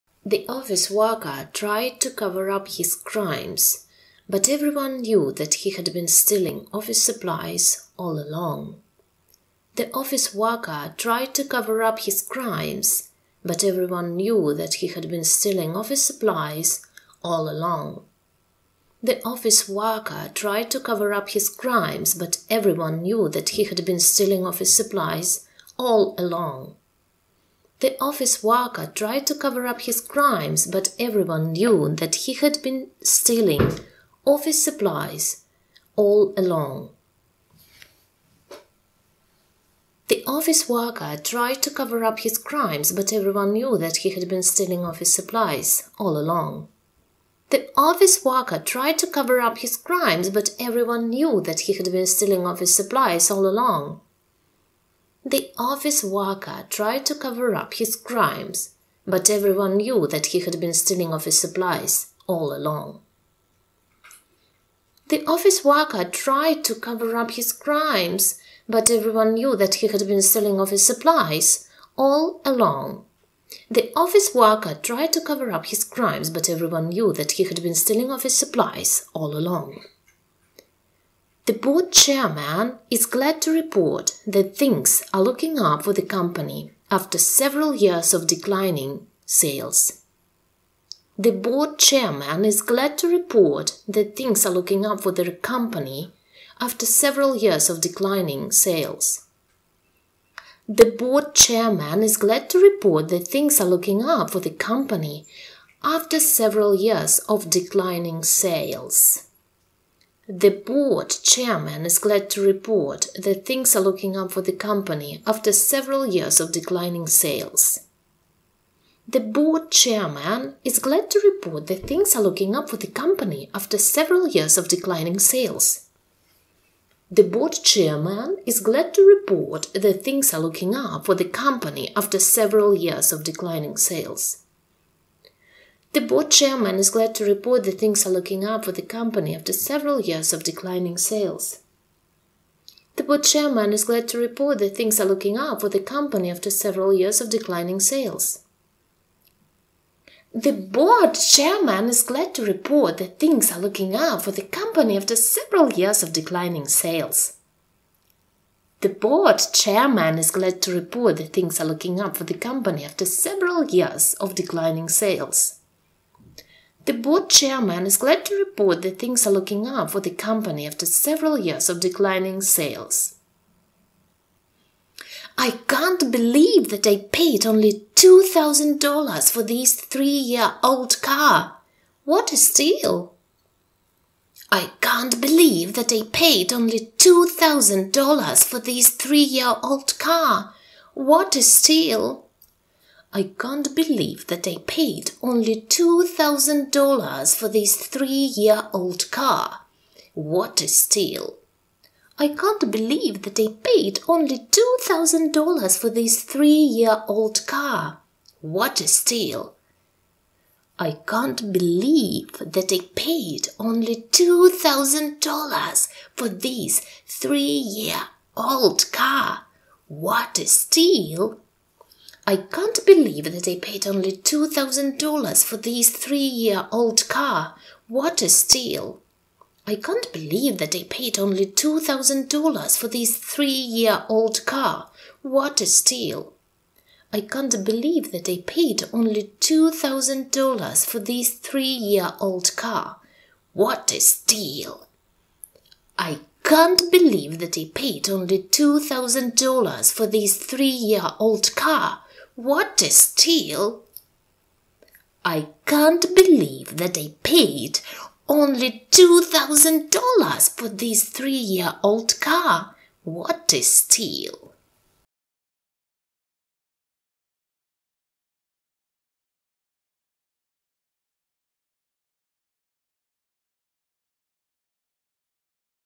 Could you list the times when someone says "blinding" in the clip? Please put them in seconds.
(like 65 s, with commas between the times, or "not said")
not said.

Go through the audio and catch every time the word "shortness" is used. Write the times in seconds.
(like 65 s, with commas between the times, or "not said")
not said.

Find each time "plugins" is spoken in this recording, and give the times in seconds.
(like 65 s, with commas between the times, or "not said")
not said.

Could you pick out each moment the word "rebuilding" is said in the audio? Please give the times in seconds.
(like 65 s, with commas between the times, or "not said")
not said.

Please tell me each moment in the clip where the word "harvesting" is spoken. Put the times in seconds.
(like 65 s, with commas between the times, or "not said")
not said.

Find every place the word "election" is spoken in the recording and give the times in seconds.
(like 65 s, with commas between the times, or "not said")
not said.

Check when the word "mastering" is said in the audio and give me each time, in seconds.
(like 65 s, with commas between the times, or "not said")
not said.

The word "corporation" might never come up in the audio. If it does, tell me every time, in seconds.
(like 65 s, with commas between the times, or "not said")
not said.